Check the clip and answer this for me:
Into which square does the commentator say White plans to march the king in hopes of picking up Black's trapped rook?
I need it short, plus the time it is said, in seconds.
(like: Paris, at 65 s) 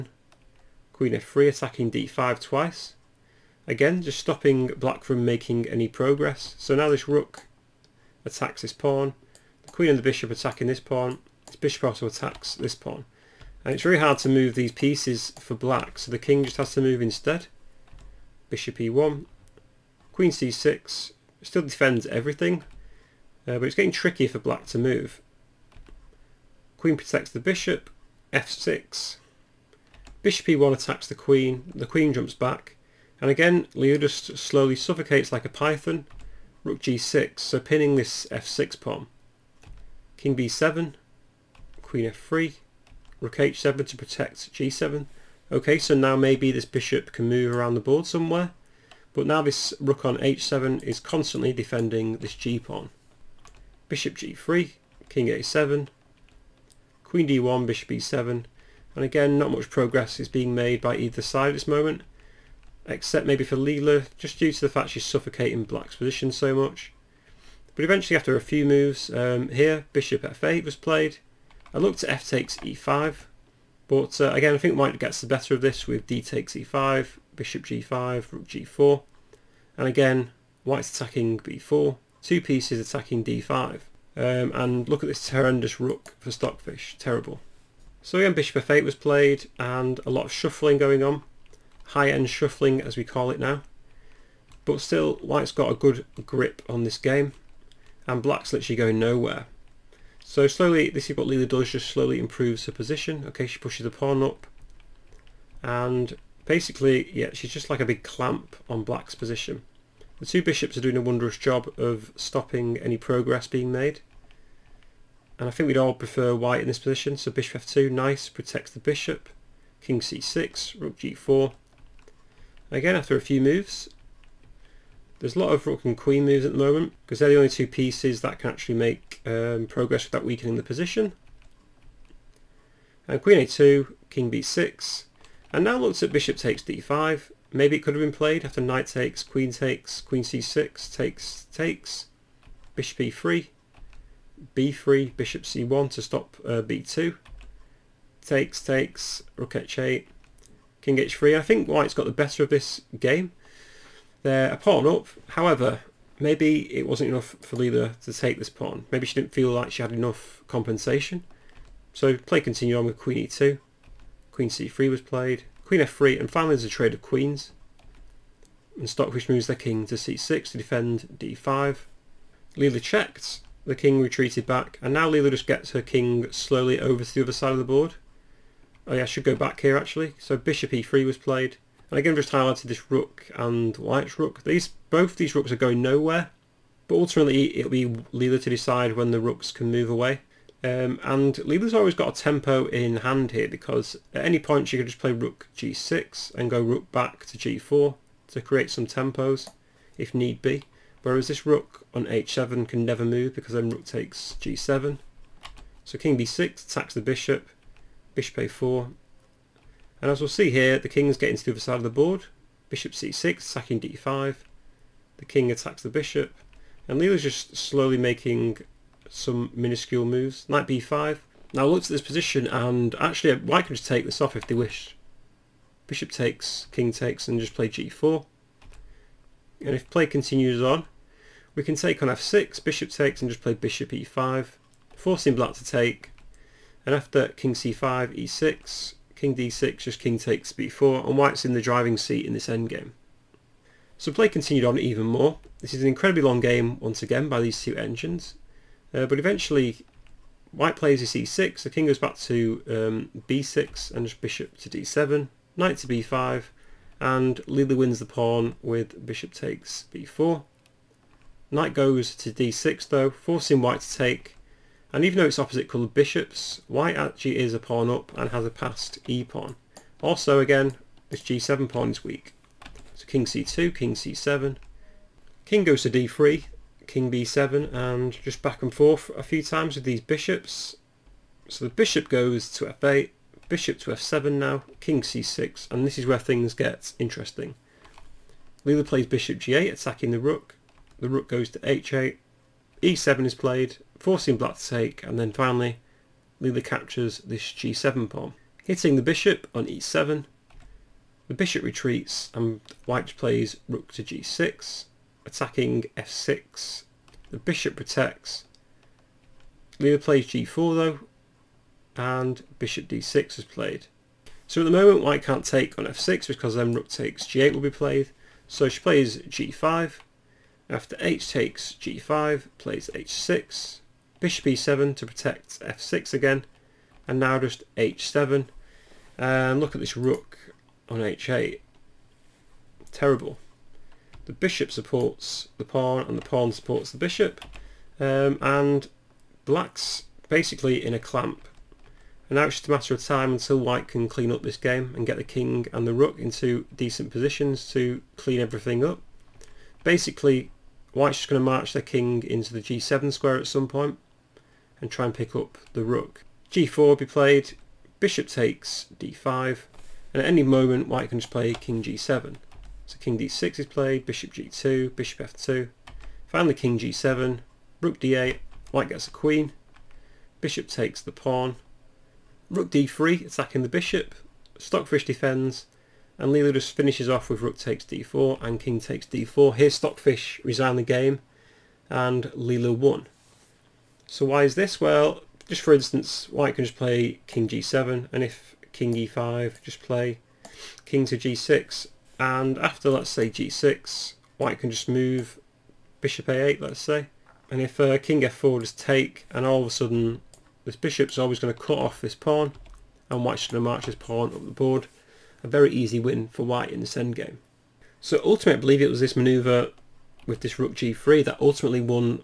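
g7, at 352 s.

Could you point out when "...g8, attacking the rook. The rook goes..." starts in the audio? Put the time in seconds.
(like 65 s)
289 s.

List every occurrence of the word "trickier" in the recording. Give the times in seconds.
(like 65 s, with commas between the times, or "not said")
23 s.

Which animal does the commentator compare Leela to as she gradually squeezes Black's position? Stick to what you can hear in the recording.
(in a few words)
Python.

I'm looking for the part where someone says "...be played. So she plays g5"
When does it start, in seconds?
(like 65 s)
317 s.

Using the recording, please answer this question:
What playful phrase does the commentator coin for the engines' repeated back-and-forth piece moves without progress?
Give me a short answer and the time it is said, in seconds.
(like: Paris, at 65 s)
High-end shuffling, at 91 s.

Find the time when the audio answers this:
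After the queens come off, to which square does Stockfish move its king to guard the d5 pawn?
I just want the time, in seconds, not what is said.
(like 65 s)
169 s.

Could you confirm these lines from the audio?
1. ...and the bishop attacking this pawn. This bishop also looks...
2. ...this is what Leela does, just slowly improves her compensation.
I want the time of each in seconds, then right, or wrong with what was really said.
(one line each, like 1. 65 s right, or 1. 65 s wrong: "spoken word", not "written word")
1. 9 s wrong: "attacks", not "looks"
2. 100 s wrong: "position", not "compensation".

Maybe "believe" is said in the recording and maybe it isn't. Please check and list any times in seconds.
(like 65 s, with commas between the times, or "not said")
408 s.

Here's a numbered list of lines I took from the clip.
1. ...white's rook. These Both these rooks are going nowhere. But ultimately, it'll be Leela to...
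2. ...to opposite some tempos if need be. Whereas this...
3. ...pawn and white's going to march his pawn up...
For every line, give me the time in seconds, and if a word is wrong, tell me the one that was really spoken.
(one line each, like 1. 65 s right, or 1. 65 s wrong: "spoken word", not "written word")
1. 183 s right
2. 198 s wrong: "create", not "opposite"
3. 402 s right.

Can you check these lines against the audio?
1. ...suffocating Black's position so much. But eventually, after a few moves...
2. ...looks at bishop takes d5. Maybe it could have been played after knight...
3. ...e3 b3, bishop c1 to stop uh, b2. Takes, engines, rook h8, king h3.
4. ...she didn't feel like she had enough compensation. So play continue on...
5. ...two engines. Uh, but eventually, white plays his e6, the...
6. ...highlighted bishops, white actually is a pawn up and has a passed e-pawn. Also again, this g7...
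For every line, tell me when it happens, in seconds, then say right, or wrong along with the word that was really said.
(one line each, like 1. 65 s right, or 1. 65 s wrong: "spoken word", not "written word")
1. 65 s right
2. 135 s right
3. 142 s wrong: "takes", not "engines"
4. 159 s right
5. 247 s right
6. 265 s wrong: "coloured", not "highlighted".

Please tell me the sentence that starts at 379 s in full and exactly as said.
Here Stockfish resign the game and Leela won.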